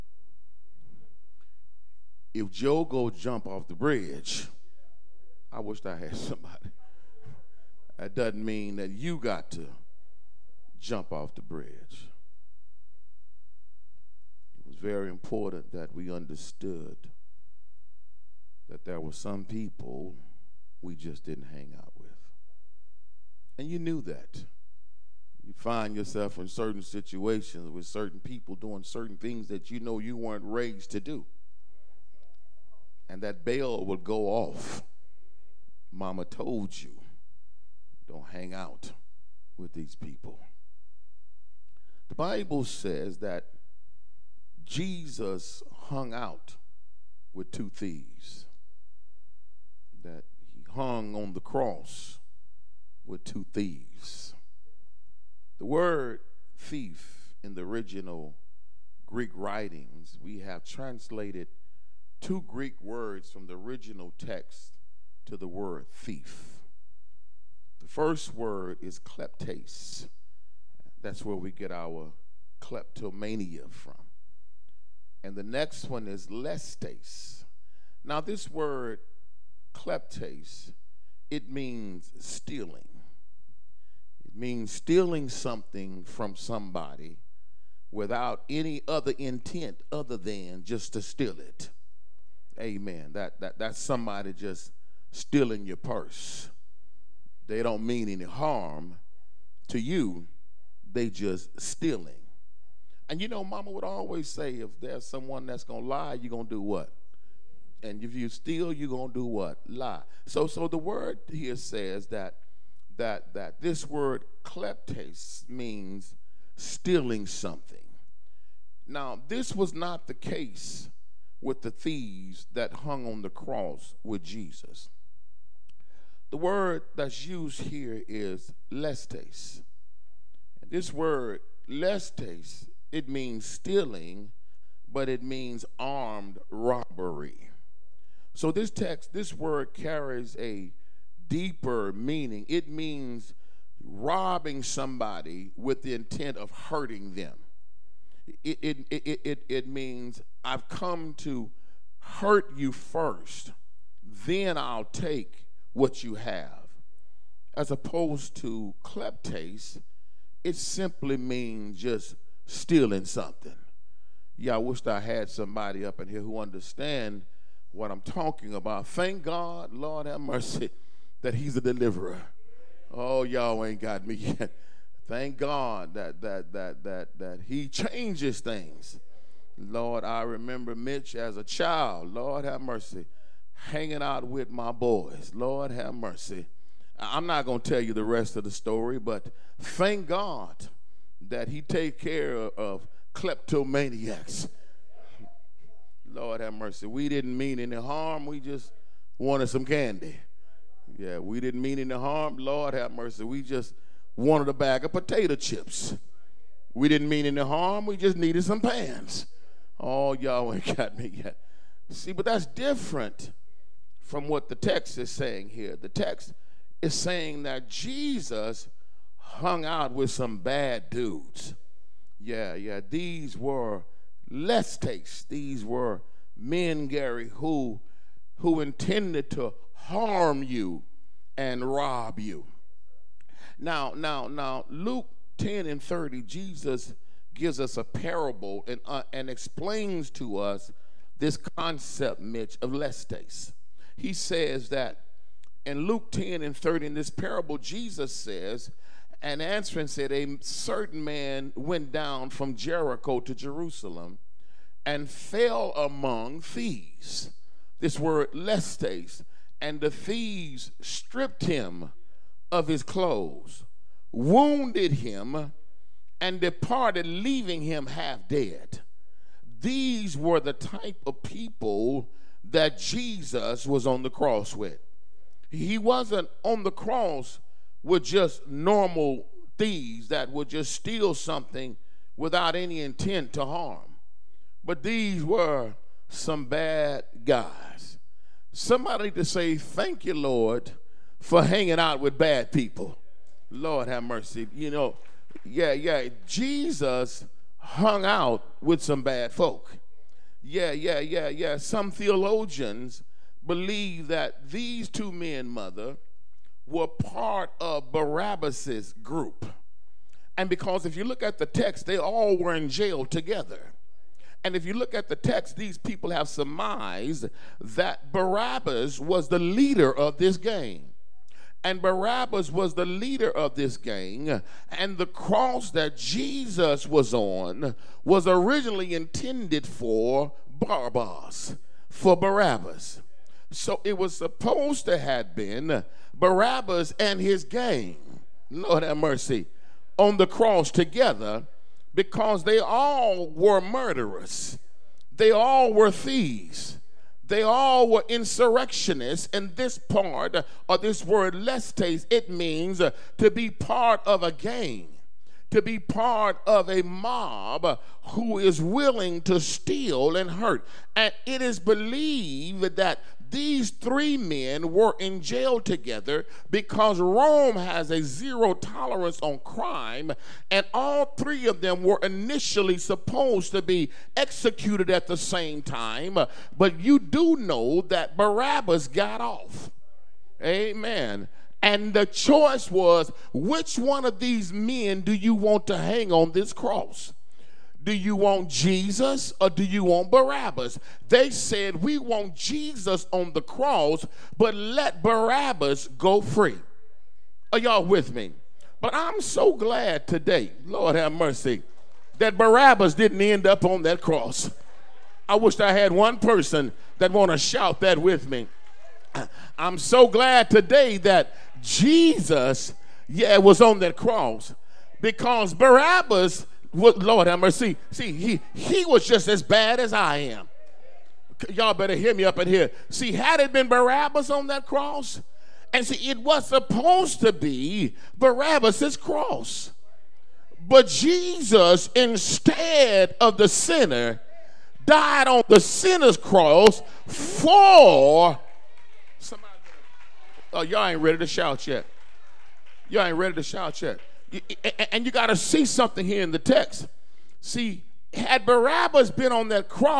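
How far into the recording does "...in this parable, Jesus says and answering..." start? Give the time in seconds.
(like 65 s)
246 s.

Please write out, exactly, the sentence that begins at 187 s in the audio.
I'm not going to tell you the rest of the story, but thank God that He take care of kleptomaniacs.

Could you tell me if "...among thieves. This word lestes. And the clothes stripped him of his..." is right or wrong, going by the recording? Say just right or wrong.
wrong.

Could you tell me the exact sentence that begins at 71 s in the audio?
That's where we get our kleptomania from.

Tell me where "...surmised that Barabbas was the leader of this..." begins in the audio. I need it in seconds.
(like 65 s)
316 s.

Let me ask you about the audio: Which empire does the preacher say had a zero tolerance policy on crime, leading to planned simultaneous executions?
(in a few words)
Rome.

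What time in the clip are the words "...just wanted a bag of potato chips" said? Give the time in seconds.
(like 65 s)
203 s.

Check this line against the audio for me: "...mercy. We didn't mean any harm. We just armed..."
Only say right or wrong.
wrong.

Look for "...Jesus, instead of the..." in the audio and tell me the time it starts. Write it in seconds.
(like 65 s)
430 s.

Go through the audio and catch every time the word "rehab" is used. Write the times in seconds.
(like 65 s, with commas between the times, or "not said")
not said.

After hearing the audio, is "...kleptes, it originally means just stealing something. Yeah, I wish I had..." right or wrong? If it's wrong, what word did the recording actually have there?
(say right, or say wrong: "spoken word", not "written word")
wrong: "simply", not "originally".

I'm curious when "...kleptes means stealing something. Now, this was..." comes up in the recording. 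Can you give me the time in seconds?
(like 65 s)
114 s.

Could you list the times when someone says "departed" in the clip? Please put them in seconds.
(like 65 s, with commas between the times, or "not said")
266 s.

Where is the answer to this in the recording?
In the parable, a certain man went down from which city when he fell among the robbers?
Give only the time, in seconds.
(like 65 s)
252 s.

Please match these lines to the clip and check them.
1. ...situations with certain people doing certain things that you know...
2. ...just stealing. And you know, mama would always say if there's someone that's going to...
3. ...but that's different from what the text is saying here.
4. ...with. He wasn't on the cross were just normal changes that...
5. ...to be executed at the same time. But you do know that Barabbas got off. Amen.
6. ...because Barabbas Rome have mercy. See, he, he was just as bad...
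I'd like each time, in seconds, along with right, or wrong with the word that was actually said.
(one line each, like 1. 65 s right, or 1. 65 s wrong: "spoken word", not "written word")
1. 26 s right
2. 101 s right
3. 212 s right
4. 274 s wrong: "thieves", not "changes"
5. 373 s right
6. 415 s wrong: "Lord", not "Rome".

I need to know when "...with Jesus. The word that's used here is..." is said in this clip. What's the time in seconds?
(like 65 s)
124 s.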